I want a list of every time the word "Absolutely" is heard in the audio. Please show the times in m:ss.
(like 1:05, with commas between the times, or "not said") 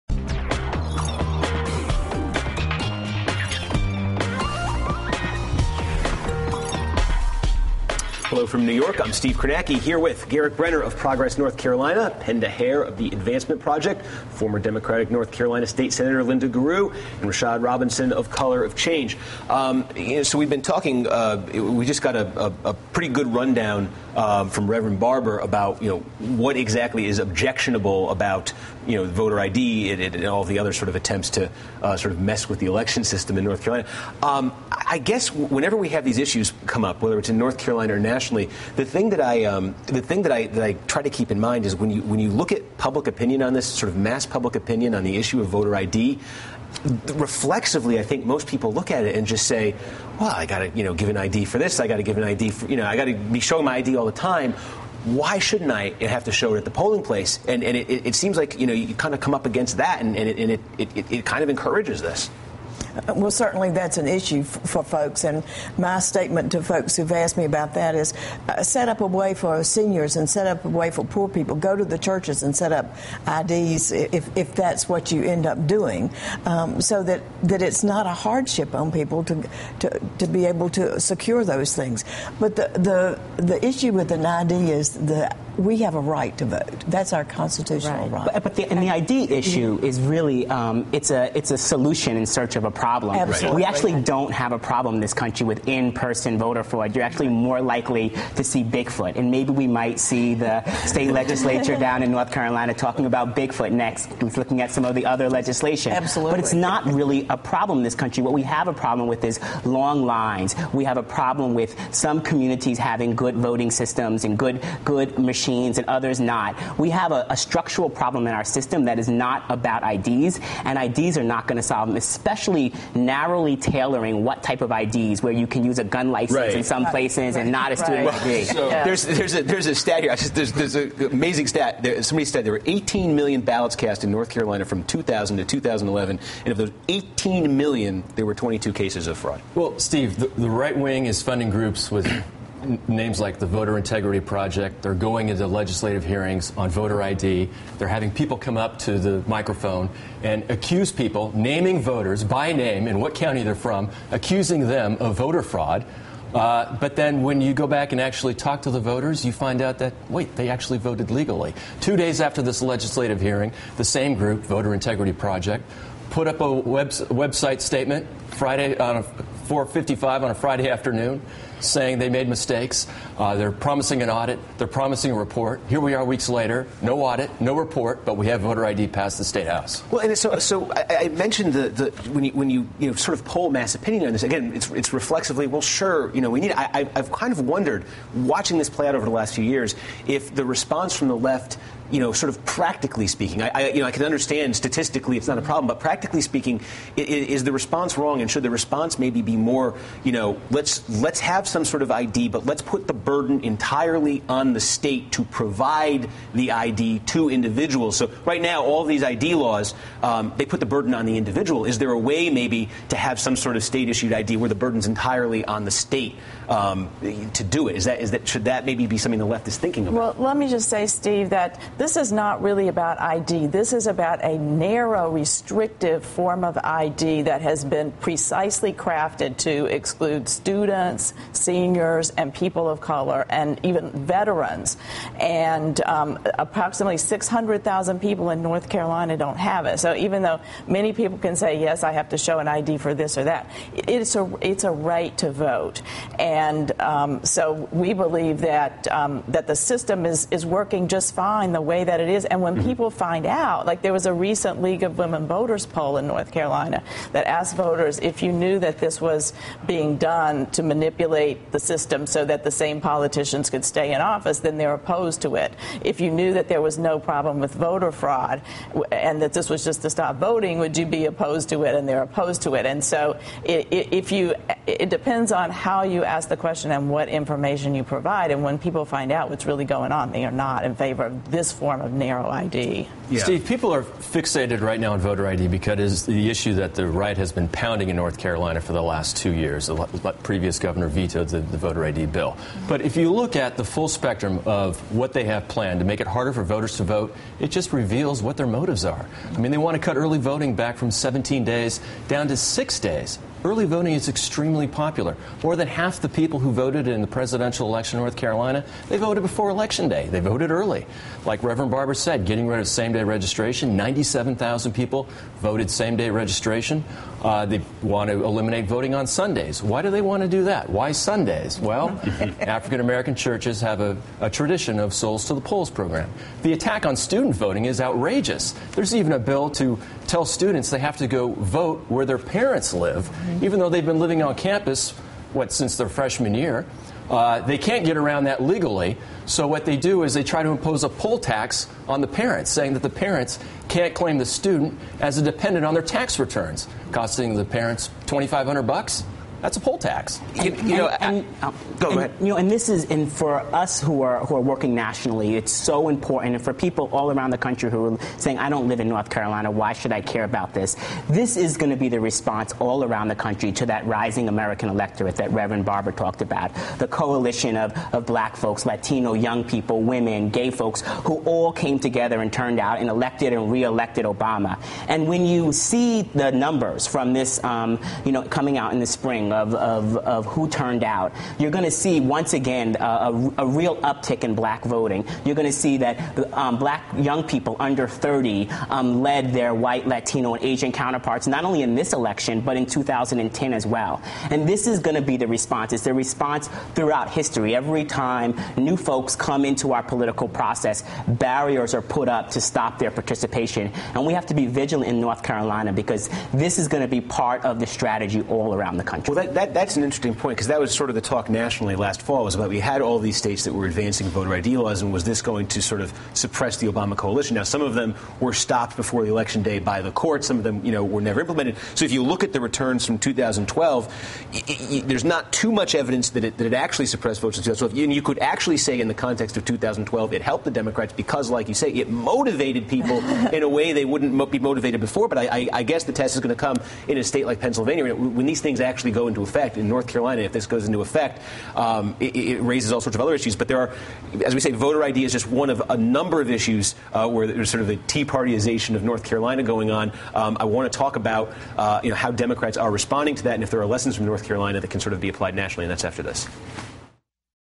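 1:33, 1:45.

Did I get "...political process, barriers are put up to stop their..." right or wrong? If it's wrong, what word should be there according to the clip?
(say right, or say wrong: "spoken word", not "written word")
right.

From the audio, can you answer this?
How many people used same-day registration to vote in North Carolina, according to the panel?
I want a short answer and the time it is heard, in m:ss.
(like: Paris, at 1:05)
97,000, at 5:13.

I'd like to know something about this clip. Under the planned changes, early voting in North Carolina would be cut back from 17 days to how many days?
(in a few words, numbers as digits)
6.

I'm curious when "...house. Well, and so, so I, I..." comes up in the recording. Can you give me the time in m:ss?
2:59.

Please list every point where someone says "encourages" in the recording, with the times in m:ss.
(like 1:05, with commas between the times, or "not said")
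1:01.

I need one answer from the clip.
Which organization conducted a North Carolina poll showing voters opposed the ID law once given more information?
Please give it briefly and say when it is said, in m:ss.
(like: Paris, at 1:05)
League of Women Voters, at 4:14.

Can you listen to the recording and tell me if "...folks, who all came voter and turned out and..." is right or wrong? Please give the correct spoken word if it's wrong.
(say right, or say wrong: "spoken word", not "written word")
wrong: "together", not "voter".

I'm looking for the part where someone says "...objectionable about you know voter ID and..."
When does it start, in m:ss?
0:27.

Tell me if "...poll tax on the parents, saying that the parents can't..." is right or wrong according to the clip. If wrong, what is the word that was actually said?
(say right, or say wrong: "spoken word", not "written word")
right.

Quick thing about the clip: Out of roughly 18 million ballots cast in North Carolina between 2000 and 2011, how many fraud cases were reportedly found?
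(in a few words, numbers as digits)
22.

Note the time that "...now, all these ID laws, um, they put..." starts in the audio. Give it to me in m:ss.
3:28.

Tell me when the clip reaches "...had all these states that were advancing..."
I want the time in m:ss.
6:52.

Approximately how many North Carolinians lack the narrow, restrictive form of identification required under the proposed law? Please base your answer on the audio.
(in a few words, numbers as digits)
600,000.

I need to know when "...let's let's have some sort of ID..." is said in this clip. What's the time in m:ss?
3:20.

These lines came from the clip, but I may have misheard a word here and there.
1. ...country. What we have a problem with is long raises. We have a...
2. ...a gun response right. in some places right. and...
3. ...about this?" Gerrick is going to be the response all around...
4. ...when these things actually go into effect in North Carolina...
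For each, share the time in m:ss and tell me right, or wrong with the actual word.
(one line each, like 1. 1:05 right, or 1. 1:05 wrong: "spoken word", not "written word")
1. 1:47 wrong: "lines", not "raises"
2. 2:05 wrong: "license", not "response"
3. 6:00 wrong: "This", not "Gerrick"
4. 7:17 right.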